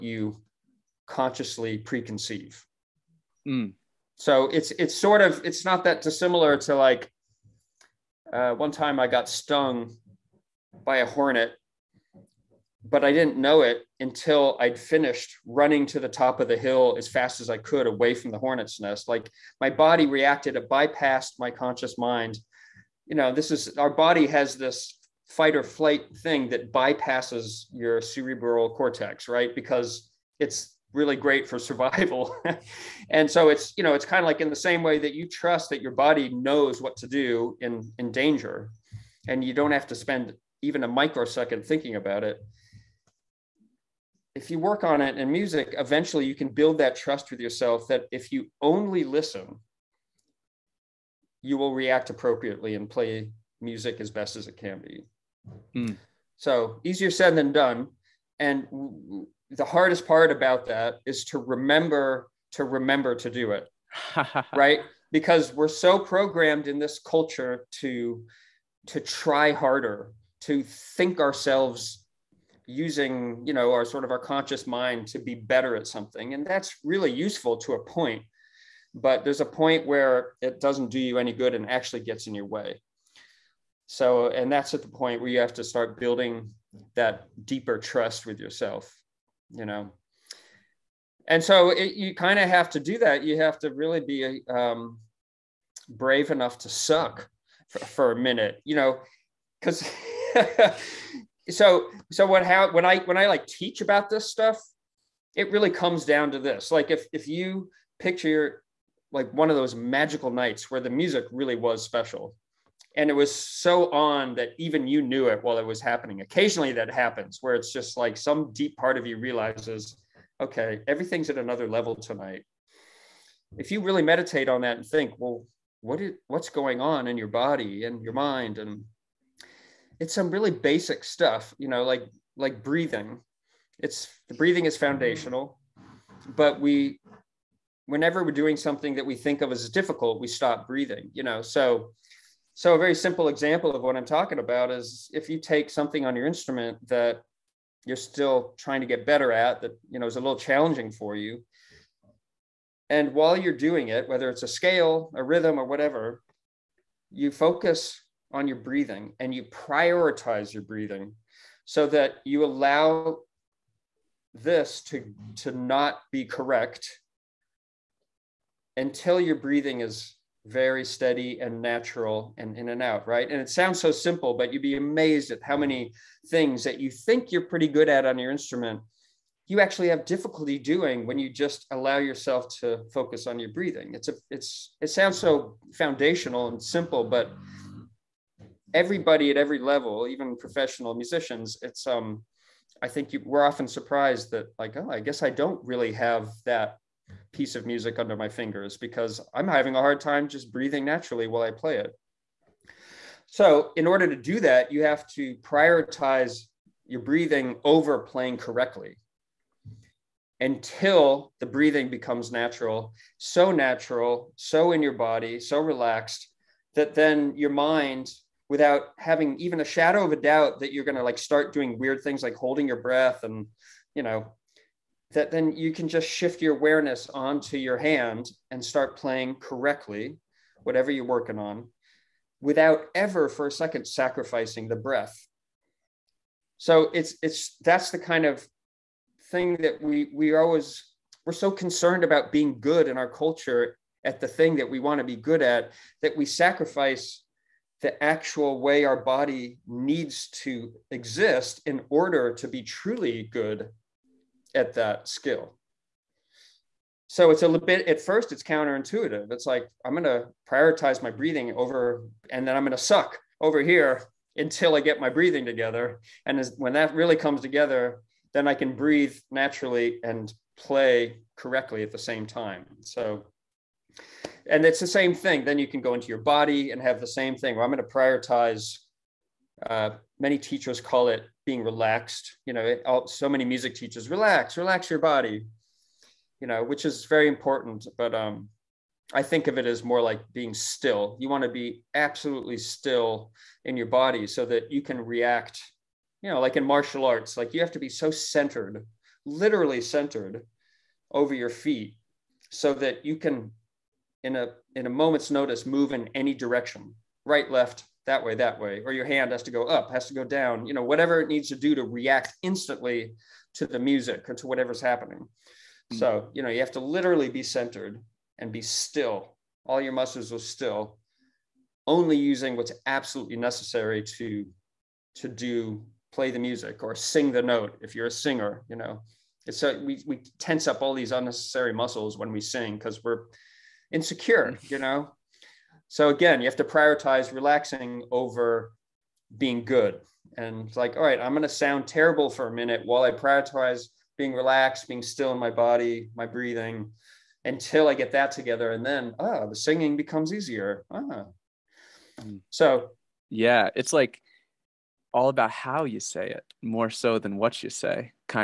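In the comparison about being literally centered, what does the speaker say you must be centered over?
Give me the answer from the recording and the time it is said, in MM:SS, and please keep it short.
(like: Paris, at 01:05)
your feet, at 05:01.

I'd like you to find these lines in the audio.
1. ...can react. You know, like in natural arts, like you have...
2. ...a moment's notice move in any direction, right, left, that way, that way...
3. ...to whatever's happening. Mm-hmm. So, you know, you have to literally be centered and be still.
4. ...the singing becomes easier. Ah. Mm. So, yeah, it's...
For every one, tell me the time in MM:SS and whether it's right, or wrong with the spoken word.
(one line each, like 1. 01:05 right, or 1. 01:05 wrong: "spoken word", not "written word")
1. 04:54 wrong: "martial", not "natural"
2. 05:04 right
3. 05:14 right
4. 05:49 right.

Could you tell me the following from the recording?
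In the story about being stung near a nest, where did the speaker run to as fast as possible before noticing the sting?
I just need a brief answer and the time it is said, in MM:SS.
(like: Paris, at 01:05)
top of the hill, at 00:16.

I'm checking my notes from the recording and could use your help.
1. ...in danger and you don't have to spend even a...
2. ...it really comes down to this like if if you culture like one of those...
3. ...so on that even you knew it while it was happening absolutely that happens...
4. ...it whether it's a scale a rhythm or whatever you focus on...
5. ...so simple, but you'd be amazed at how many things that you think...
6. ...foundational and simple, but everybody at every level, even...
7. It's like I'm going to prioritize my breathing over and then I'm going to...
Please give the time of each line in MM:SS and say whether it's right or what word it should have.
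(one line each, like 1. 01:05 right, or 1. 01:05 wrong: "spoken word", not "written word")
1. 00:37 right
2. 01:45 wrong: "picture", not "culture"
3. 01:53 wrong: "occasionally", not "absolutely"
4. 02:33 right
5. 02:53 right
6. 03:05 right
7. 04:19 right.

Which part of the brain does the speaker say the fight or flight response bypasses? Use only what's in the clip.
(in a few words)
cerebral cortex.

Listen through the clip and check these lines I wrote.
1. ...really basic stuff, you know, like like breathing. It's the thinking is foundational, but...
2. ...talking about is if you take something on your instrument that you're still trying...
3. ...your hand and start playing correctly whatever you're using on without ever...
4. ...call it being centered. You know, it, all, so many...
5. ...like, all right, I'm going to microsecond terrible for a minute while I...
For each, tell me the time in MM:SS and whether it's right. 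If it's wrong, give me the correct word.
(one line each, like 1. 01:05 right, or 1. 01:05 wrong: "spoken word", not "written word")
1. 02:10 wrong: "breathing", not "thinking"
2. 02:24 right
3. 03:47 wrong: "working", not "using"
4. 04:40 wrong: "relaxed", not "centered"
5. 05:40 wrong: "sound", not "microsecond".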